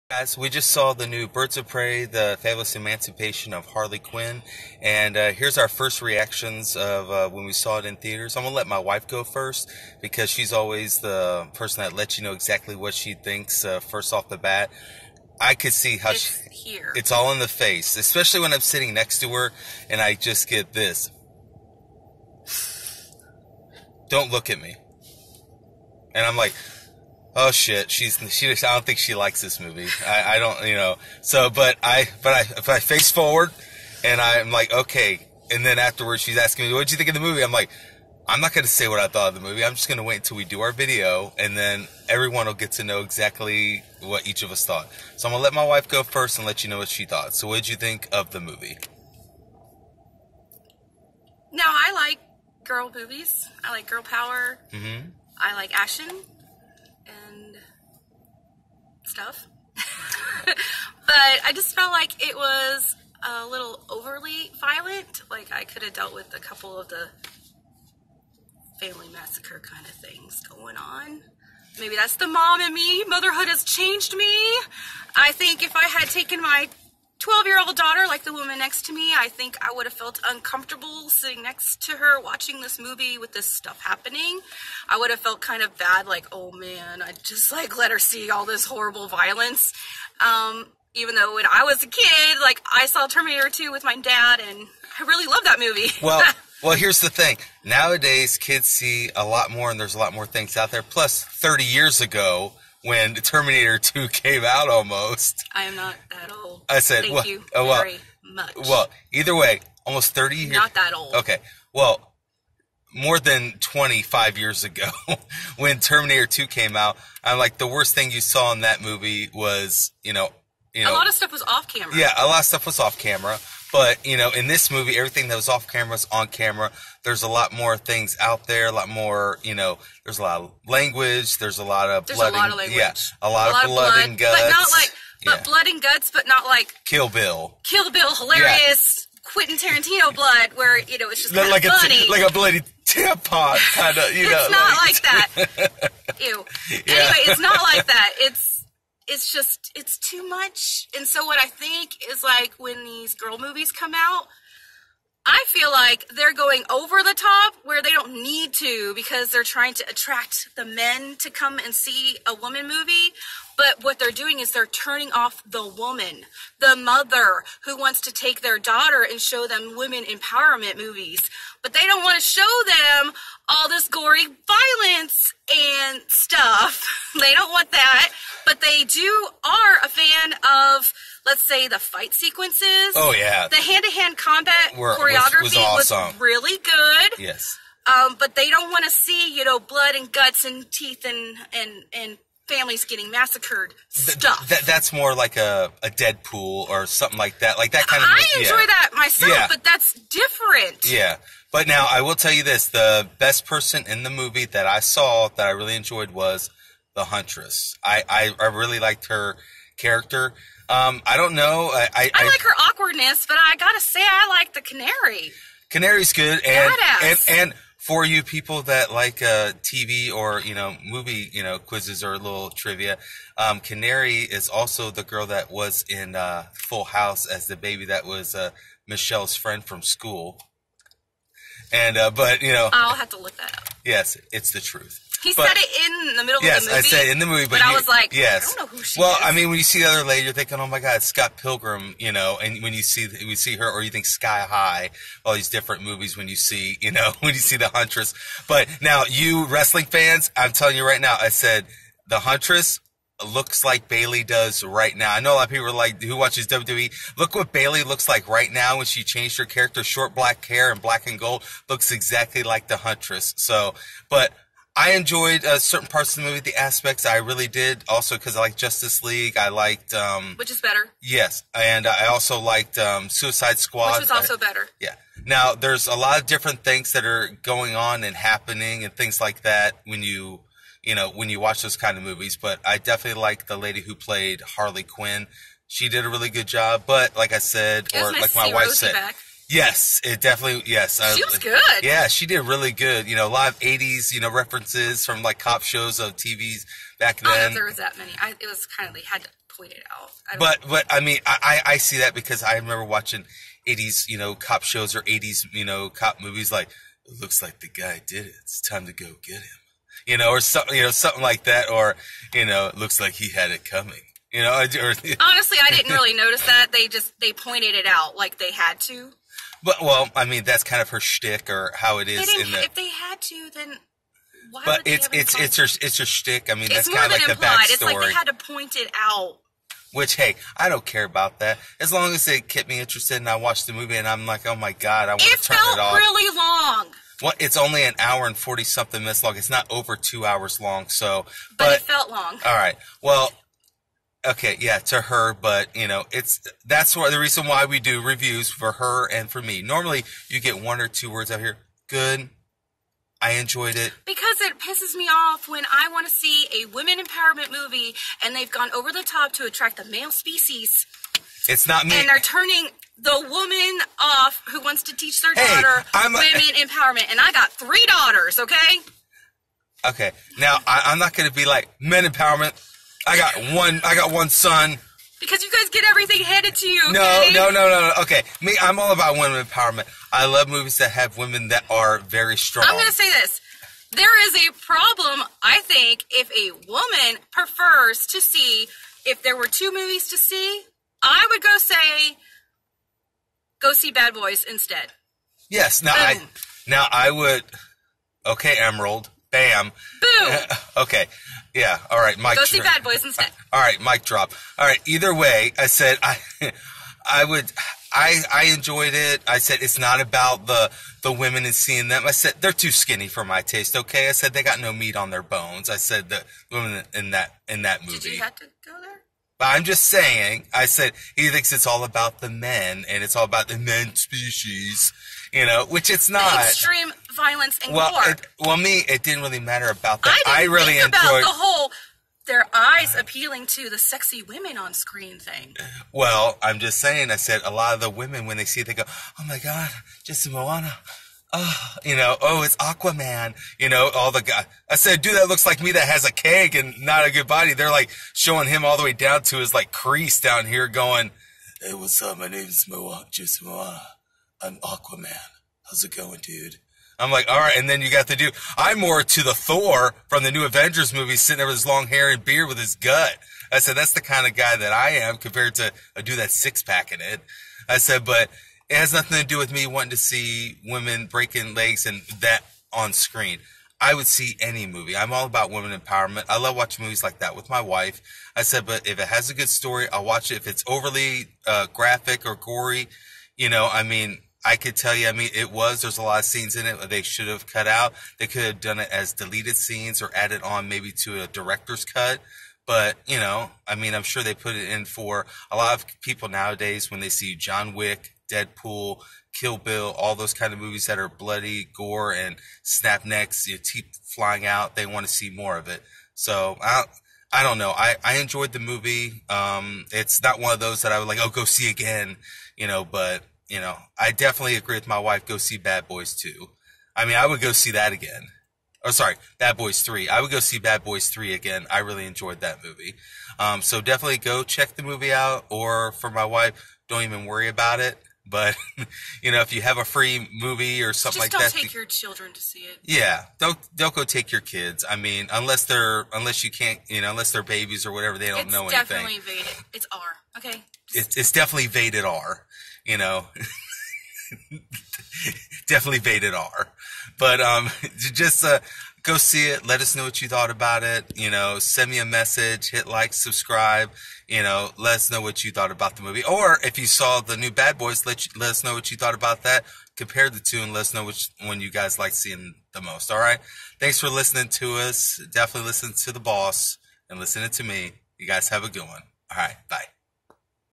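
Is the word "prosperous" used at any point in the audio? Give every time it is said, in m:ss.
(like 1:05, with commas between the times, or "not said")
not said.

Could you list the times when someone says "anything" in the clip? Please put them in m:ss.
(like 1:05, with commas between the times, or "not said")
8:58.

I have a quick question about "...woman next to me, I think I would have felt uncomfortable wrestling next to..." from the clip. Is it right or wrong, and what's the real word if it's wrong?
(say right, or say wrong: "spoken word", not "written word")
wrong: "sitting", not "wrestling".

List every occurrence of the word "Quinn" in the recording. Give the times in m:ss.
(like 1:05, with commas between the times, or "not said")
0:03, 4:44.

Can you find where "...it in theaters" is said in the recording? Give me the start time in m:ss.
0:07.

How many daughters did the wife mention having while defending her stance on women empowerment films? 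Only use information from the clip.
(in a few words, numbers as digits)
3.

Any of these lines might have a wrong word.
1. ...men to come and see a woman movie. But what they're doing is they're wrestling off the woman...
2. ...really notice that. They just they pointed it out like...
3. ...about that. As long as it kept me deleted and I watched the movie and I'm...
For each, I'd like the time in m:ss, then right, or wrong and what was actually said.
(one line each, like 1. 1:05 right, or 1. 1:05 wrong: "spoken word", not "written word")
1. 2:40 wrong: "turning", not "wrestling"
2. 5:15 right
3. 5:31 wrong: "interested", not "deleted".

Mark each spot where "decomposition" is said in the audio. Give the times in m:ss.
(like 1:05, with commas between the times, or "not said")
not said.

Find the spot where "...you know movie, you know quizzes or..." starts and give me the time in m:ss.
3:40.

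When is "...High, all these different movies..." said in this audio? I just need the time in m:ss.
4:04.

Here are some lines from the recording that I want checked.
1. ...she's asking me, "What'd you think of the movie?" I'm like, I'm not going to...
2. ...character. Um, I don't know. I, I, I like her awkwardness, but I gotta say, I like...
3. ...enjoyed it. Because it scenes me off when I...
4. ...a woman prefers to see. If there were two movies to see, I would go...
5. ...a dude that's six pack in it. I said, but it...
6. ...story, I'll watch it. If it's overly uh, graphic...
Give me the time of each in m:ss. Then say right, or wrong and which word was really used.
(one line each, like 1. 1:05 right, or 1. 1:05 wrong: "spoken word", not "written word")
1. 0:36 right
2. 3:29 right
3. 5:53 wrong: "pisses", not "scenes"
4. 6:26 right
5. 7:45 right
6. 7:59 right.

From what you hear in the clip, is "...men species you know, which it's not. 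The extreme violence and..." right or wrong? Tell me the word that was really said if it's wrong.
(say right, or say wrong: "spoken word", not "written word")
right.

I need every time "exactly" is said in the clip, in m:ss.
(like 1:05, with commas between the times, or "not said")
0:12, 0:43, 4:21.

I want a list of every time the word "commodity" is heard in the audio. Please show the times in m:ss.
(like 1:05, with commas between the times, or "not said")
not said.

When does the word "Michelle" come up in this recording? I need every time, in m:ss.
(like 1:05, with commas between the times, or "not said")
3:48.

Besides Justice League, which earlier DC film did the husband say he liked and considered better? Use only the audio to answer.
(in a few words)
Suicide Squad.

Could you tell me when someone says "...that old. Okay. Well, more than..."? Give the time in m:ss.
1:50.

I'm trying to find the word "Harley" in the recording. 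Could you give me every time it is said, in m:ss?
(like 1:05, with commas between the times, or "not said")
0:03, 4:44.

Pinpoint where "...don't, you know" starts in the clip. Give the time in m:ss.
0:30.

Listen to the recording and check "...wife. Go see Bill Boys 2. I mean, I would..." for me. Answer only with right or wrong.
wrong.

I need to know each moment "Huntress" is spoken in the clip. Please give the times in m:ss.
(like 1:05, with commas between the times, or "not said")
3:27, 4:07, 4:12, 4:22.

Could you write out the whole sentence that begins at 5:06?
Like, it looks like the guy did it.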